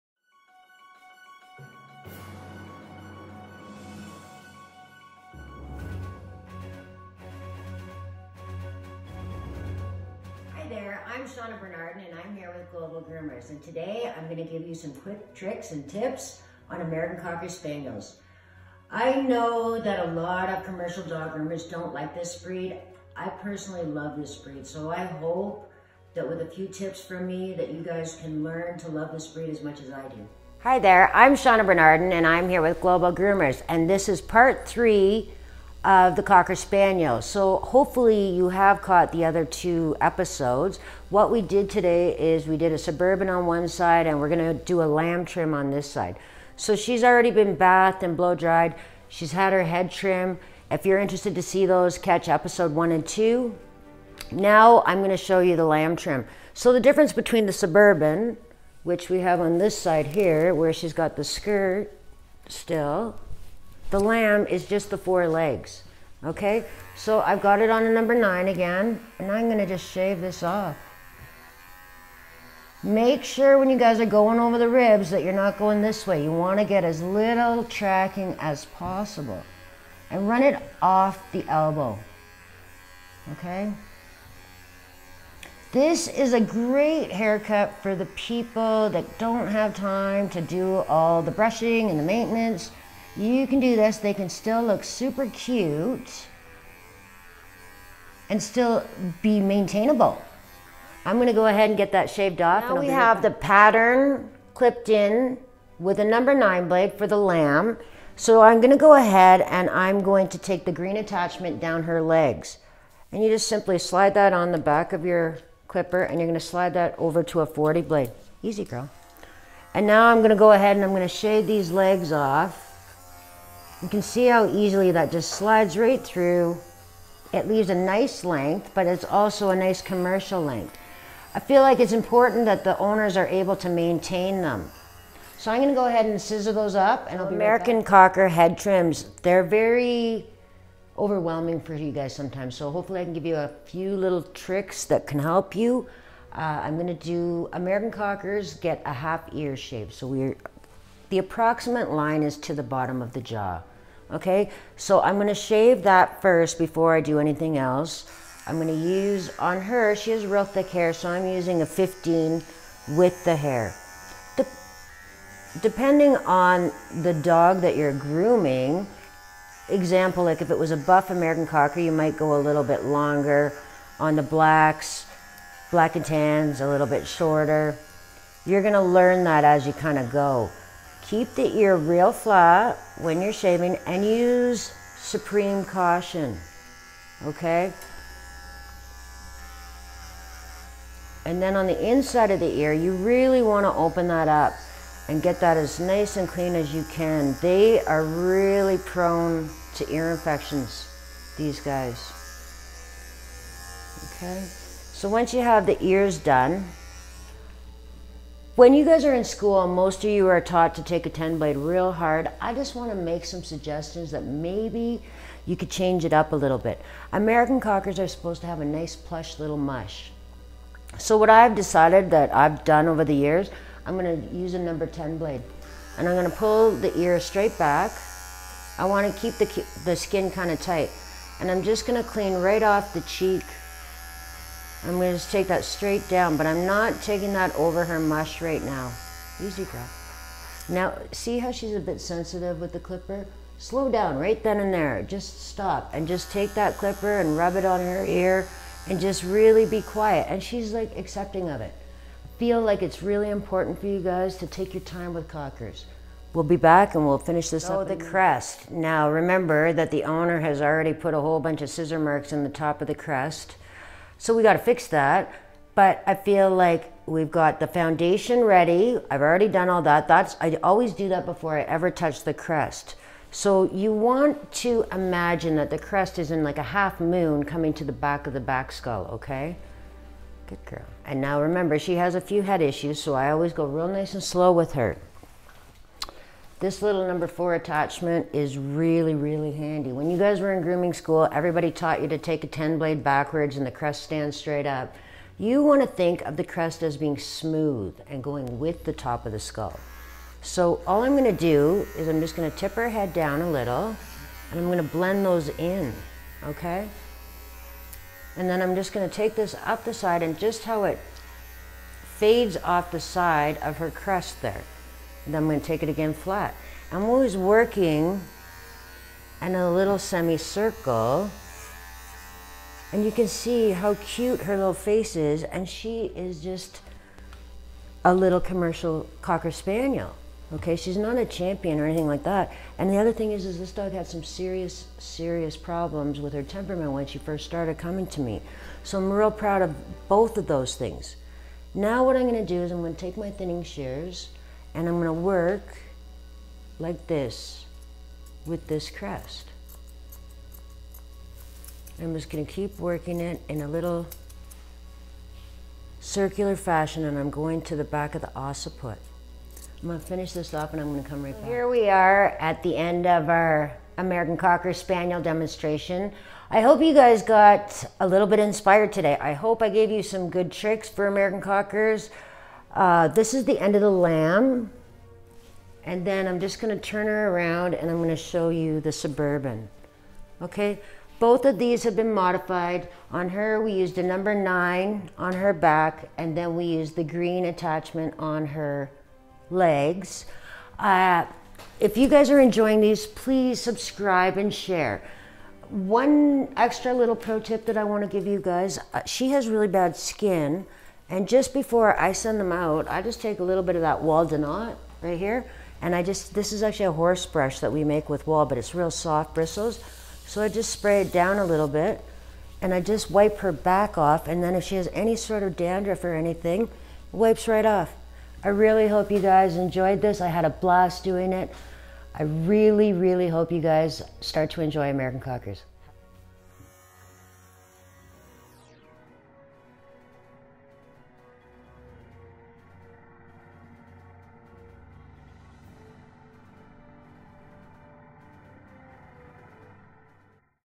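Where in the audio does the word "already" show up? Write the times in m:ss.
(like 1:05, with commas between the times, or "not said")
0:47, 4:20, 4:29.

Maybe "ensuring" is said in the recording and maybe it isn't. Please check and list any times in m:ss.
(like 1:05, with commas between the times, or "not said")
not said.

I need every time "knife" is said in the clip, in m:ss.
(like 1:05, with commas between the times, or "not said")
not said.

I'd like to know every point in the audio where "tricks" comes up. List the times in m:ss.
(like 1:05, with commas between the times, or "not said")
0:15, 2:24, 6:10.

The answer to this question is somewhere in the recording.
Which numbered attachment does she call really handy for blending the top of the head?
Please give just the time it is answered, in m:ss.
4:47.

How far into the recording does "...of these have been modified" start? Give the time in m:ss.
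6:21.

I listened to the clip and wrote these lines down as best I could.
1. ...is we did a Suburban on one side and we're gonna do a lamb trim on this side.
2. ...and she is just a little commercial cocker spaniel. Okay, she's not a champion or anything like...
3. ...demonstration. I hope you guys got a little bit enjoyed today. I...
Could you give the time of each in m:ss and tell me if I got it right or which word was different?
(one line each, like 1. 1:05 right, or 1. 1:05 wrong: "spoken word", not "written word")
1. 0:42 right
2. 5:25 right
3. 6:05 wrong: "inspired", not "enjoyed".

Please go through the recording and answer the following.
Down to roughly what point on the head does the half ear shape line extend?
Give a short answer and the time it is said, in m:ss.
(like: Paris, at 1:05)
bottom of the jaw, at 2:32.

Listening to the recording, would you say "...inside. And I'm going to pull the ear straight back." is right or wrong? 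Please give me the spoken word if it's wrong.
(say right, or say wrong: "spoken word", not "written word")
wrong: "blade", not "inside".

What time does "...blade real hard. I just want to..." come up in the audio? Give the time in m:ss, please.
3:31.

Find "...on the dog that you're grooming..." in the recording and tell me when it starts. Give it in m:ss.
2:46.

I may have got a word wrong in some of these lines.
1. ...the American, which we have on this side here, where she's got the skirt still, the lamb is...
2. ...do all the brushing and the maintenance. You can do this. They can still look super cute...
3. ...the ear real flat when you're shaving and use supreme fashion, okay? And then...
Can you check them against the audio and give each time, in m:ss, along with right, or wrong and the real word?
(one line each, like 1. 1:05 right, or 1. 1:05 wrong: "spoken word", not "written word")
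1. 0:57 wrong: "Suburban", not "American"
2. 1:30 right
3. 3:01 wrong: "caution", not "fashion".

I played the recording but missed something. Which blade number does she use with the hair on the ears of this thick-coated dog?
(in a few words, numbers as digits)
15.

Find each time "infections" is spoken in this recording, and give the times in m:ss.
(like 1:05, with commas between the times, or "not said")
3:20.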